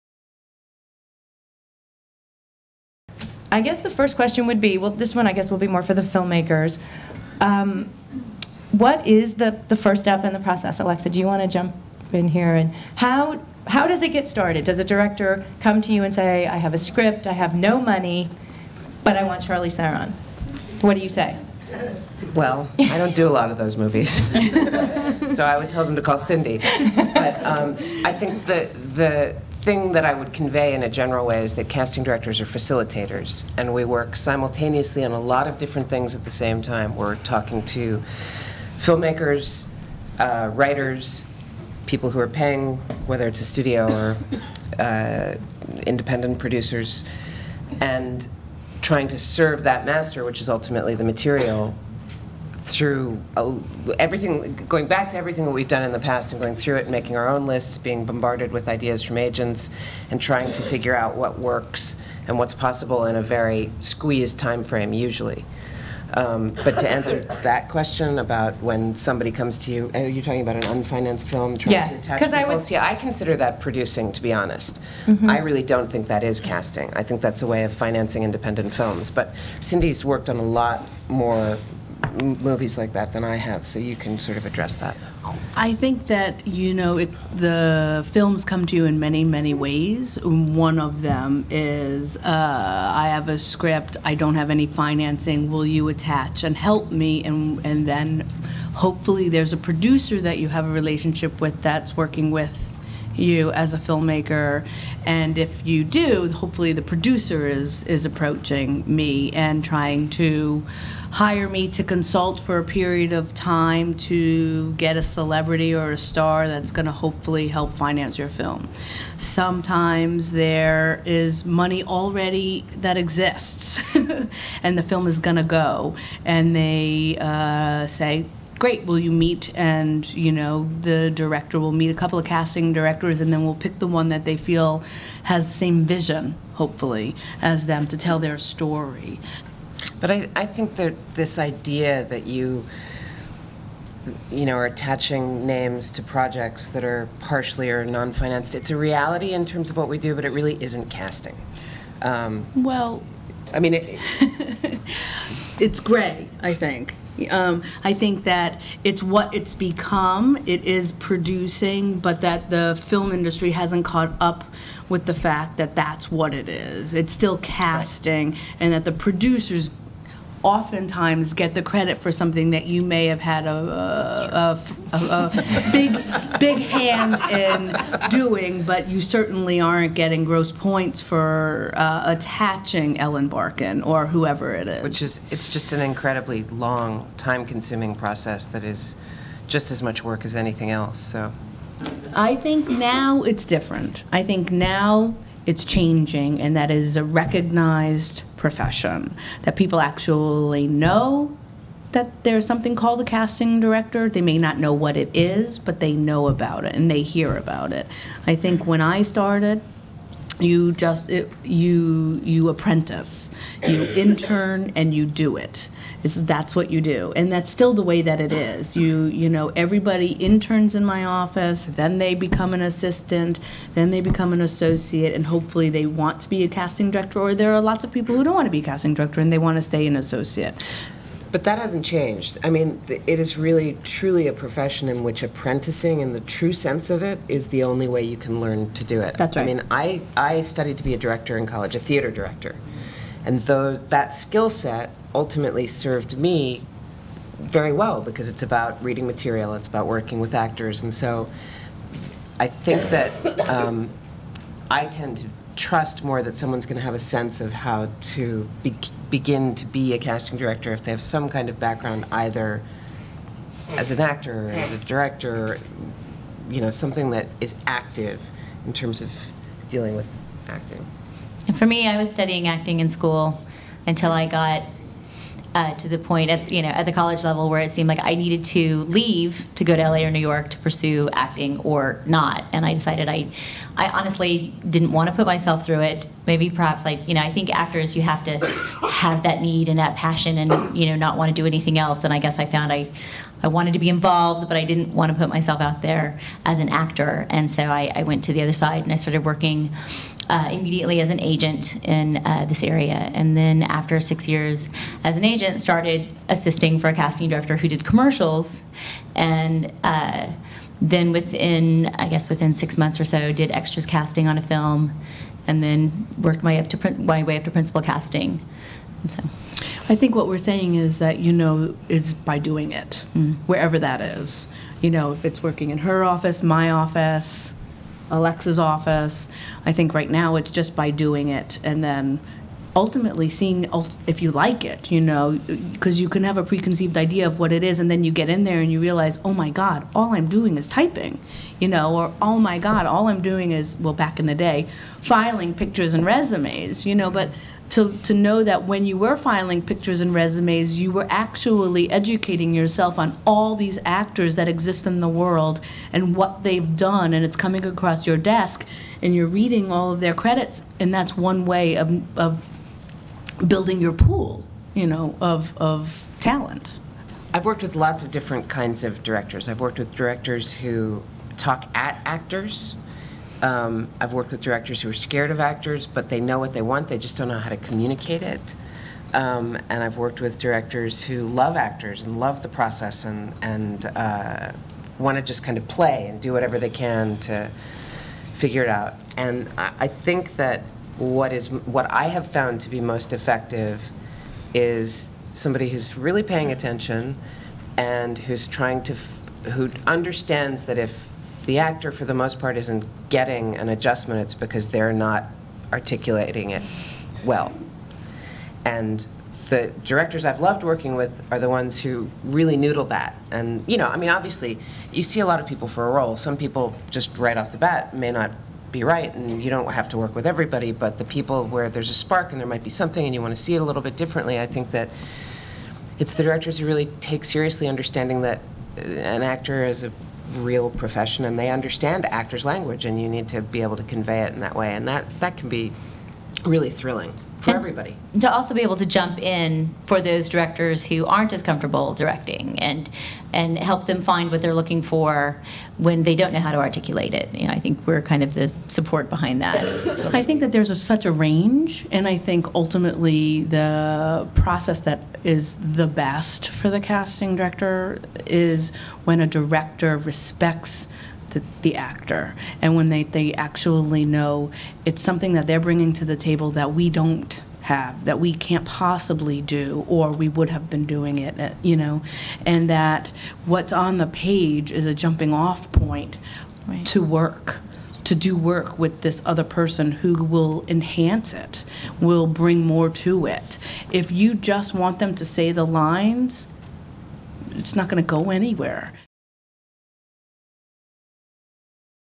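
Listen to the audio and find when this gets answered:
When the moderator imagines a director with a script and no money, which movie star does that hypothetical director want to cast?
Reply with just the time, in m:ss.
0:19.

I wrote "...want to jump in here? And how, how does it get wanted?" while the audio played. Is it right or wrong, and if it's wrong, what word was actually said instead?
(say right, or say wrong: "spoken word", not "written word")
wrong: "started", not "wanted".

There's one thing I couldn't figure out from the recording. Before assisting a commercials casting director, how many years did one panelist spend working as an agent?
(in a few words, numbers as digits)
6.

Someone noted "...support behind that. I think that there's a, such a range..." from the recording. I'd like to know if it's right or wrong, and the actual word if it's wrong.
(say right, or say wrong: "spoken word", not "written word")
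right.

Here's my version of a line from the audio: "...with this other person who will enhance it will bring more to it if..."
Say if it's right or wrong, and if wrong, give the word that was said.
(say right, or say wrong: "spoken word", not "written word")
right.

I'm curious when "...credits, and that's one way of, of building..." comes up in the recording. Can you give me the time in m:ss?
6:00.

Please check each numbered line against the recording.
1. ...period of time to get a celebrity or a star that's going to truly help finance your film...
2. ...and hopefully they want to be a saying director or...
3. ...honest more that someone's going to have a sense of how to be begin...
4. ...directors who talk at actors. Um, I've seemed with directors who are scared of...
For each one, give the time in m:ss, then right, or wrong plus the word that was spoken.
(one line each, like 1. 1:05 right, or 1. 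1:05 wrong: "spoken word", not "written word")
1. 1:52 wrong: "hopefully", not "truly"
2. 3:45 wrong: "casting", not "saying"
3. 4:15 wrong: "trust", not "honest"
4. 6:09 wrong: "worked", not "seemed".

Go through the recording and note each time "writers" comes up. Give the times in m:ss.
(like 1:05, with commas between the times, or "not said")
0:40.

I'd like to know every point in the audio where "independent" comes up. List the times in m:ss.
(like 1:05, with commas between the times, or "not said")
0:45, 1:18.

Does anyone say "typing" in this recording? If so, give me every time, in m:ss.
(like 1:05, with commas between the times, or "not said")
5:40.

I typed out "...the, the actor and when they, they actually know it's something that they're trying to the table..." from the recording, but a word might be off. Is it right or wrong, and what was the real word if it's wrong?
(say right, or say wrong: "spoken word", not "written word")
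wrong: "bringing", not "trying".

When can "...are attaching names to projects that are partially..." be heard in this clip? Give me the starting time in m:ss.
2:24.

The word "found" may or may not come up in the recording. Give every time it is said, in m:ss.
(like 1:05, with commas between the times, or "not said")
4:52, 6:32.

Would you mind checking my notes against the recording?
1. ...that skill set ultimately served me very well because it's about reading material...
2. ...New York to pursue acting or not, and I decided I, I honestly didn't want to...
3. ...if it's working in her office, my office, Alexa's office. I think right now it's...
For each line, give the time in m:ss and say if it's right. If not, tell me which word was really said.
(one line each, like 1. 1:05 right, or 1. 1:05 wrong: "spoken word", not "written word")
1. 4:03 right
2. 4:40 right
3. 5:25 right.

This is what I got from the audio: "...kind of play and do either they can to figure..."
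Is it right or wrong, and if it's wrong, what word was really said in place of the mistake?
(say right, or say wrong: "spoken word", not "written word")
wrong: "whatever", not "either".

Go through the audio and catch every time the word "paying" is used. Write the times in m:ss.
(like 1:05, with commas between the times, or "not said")
0:42, 6:36.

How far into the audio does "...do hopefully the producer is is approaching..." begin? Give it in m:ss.
1:45.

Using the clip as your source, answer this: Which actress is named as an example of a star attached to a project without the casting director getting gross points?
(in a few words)
Ellen Barkin.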